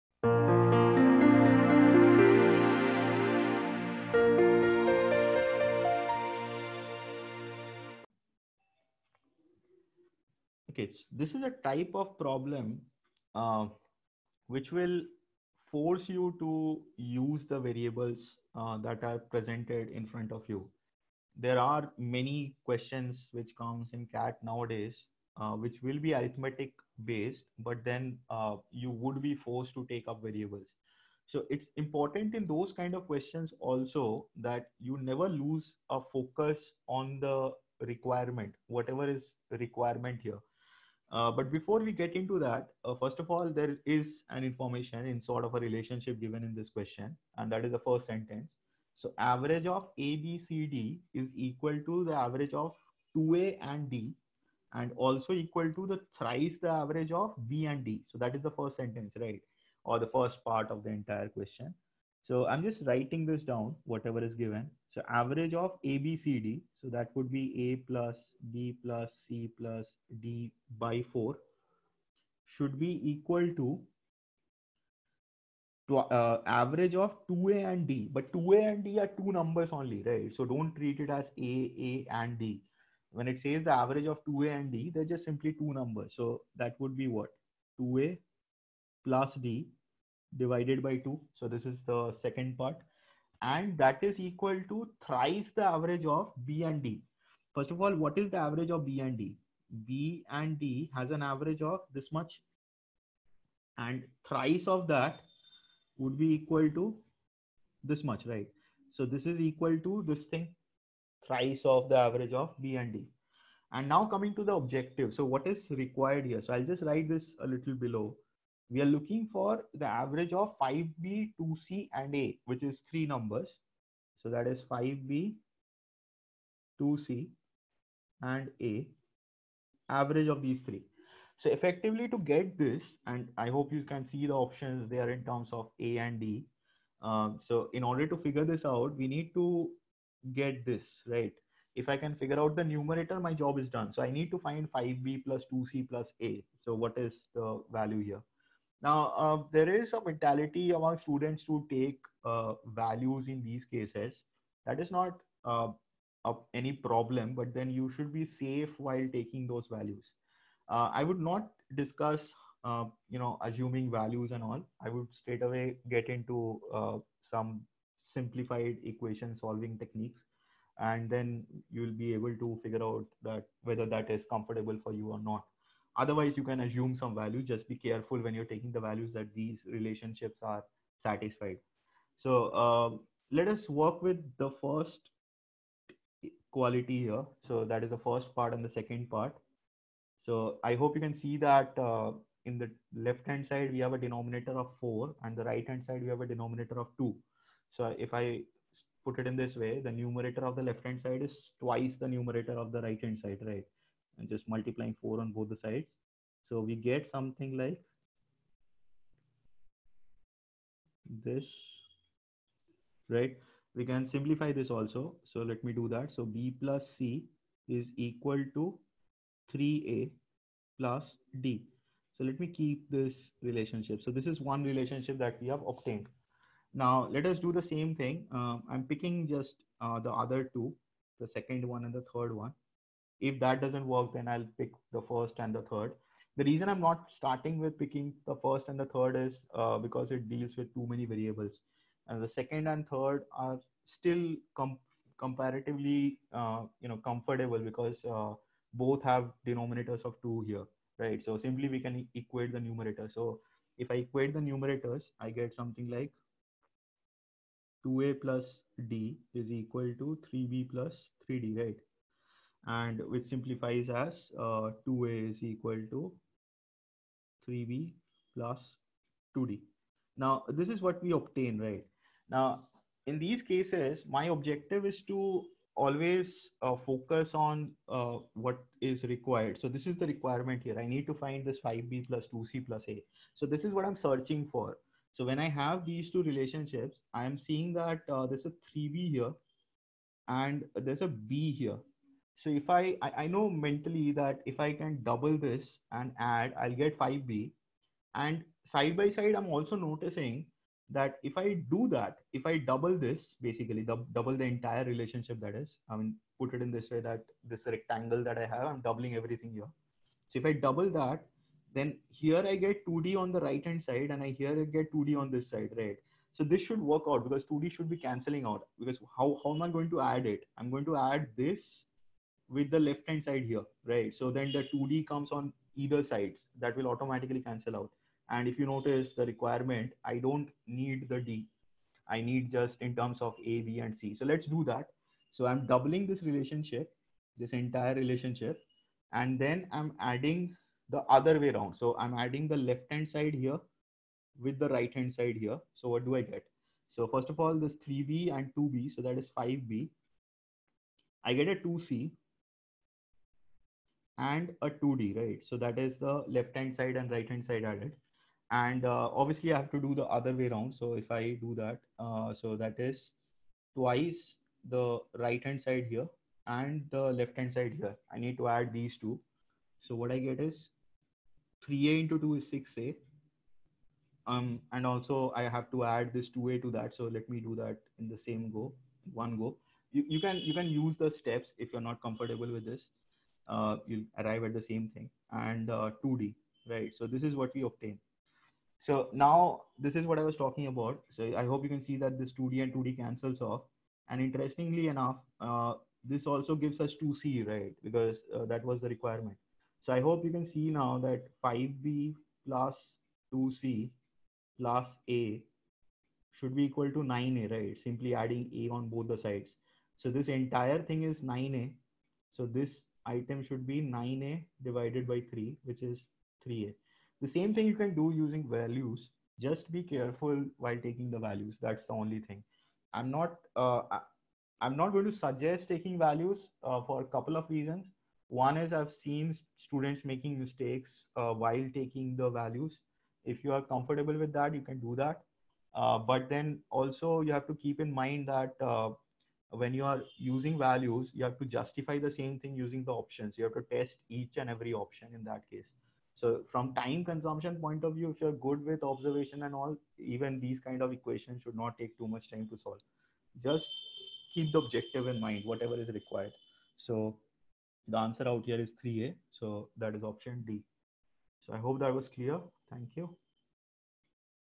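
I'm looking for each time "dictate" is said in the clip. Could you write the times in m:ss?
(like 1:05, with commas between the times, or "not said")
not said.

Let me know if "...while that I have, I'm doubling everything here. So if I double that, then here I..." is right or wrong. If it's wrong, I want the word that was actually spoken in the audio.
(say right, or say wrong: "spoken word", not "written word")
wrong: "rectangle", not "while".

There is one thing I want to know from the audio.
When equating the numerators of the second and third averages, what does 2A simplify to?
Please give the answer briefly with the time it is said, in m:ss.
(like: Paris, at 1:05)
3B + 2D, at 4:27.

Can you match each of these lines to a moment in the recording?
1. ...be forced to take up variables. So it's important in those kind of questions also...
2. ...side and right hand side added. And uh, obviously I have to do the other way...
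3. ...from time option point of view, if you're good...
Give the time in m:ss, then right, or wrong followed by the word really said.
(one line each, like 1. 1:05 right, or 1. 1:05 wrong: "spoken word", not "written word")
1. 0:29 right
2. 5:56 right
3. 7:26 wrong: "consumption", not "option".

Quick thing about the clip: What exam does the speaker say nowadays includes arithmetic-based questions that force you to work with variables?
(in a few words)
CAT.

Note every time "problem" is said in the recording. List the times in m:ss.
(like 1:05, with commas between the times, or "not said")
0:12, 2:36.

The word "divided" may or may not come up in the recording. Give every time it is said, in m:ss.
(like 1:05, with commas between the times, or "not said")
1:30, 6:54.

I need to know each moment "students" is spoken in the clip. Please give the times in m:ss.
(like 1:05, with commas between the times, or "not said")
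2:30, 7:09.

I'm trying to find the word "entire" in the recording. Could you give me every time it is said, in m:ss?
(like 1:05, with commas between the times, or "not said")
1:00, 5:04, 5:37, 6:50.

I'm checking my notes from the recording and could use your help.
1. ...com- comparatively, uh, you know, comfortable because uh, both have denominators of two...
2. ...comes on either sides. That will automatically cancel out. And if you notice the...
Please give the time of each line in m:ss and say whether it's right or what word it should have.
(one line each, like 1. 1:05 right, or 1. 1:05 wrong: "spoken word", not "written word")
1. 4:04 right
2. 5:25 right.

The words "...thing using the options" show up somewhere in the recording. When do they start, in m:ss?
7:22.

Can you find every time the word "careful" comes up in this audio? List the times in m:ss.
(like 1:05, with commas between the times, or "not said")
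2:57, 6:59.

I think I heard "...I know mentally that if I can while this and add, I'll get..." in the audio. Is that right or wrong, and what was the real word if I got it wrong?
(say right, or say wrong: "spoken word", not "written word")
wrong: "double", not "while".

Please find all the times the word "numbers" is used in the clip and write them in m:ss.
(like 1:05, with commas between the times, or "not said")
1:19, 1:25, 2:03.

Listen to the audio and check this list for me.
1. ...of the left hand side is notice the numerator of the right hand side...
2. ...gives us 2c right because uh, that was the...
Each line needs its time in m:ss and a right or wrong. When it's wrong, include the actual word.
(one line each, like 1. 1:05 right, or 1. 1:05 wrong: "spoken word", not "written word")
1. 3:20 wrong: "twice", not "notice"
2. 6:36 right.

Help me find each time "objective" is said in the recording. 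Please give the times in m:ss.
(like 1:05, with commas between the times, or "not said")
1:54, 4:34, 7:34.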